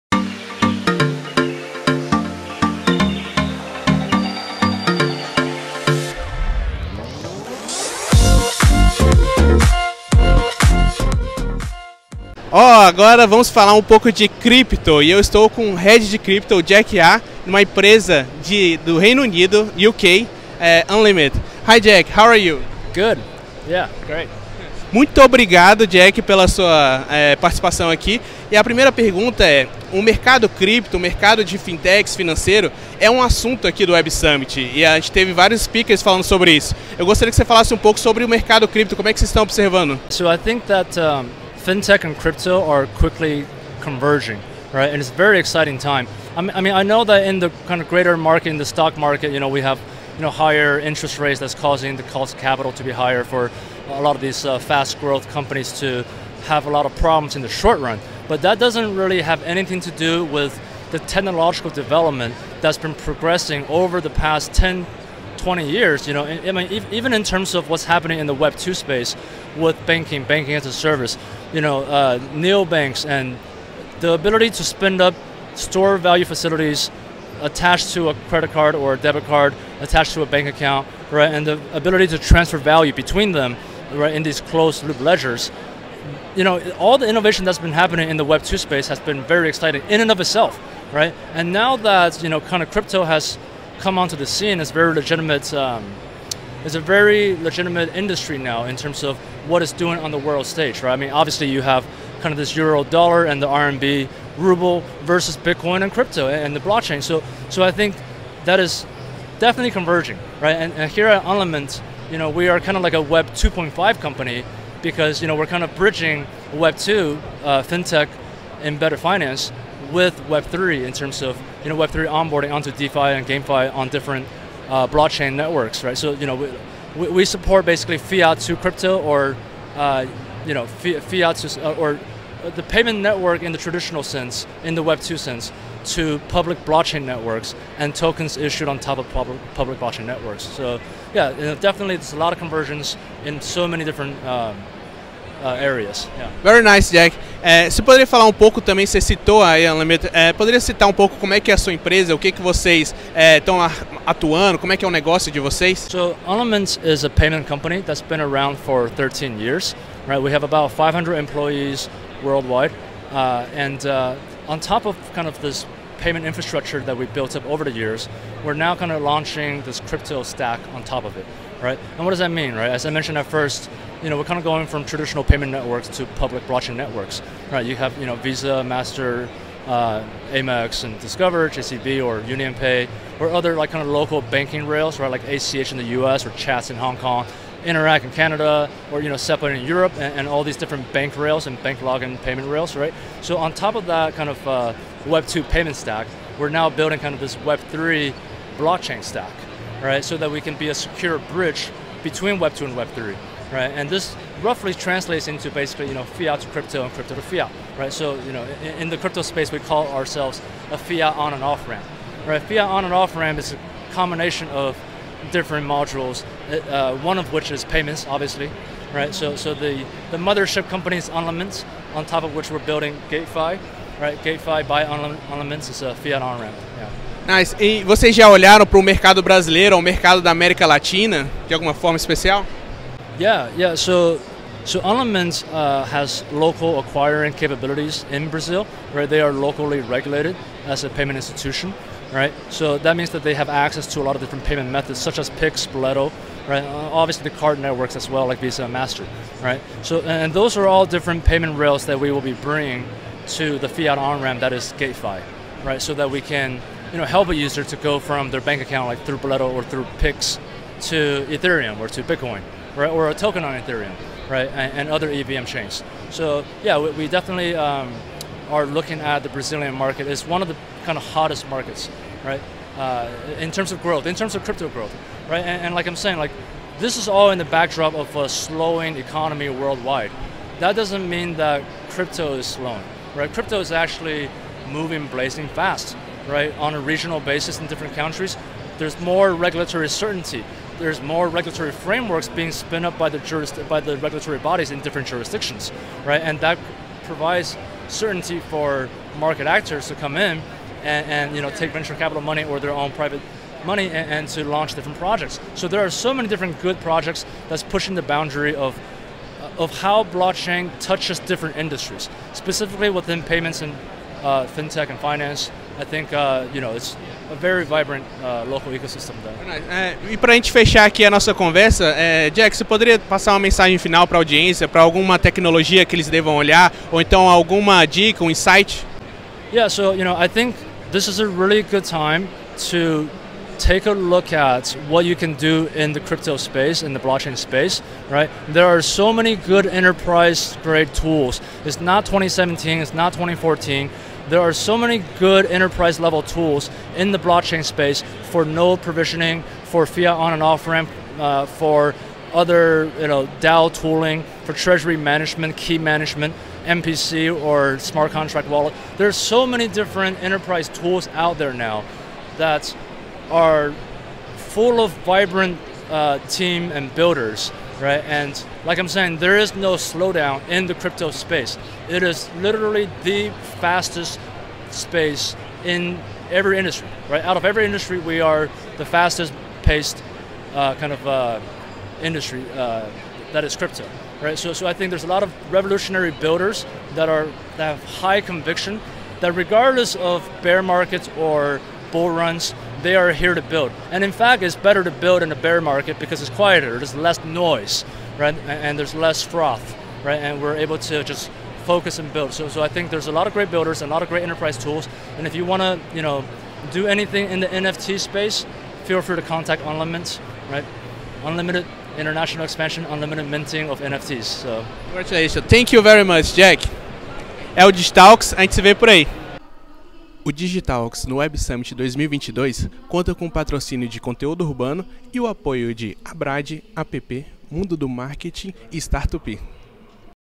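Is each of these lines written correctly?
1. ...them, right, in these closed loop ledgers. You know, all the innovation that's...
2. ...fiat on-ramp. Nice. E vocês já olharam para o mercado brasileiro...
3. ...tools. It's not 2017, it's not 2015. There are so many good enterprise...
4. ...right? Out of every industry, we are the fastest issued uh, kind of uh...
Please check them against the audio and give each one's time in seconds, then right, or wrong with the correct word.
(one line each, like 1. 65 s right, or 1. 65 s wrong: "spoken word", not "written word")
1. 83 s right
2. 225 s right
3. 340 s wrong: "2014", not "2015"
4. 377 s wrong: "paced", not "issued".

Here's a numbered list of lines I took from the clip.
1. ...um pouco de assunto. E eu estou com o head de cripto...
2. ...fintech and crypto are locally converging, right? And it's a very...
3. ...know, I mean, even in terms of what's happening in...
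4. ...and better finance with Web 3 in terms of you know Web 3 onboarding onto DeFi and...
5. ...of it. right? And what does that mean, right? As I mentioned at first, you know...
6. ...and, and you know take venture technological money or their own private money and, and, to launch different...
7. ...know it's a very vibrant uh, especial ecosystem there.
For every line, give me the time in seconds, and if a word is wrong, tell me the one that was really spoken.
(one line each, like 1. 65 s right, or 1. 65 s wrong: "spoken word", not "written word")
1. 13 s wrong: "cripto", not "assunto"
2. 41 s wrong: "quickly", not "locally"
3. 66 s right
4. 118 s right
5. 171 s right
6. 300 s wrong: "capital", not "technological"
7. 316 s wrong: "local", not "especial".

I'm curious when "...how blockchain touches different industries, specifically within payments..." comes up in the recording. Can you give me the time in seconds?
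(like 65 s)
309 s.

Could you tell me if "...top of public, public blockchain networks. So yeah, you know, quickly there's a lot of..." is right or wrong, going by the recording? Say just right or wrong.
wrong.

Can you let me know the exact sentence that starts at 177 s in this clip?
You have, you know, Visa, Master, uh, Amex and Discover, JCB or UnionPay, or other like kind of local banking rails, right?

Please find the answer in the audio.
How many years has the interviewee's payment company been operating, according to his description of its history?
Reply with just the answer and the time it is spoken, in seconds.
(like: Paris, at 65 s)
13, at 158 s.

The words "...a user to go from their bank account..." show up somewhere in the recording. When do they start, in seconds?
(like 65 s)
257 s.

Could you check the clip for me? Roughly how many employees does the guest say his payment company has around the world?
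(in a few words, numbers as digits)
500.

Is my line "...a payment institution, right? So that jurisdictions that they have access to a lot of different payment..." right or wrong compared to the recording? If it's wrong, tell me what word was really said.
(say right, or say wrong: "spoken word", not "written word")
wrong: "means", not "jurisdictions".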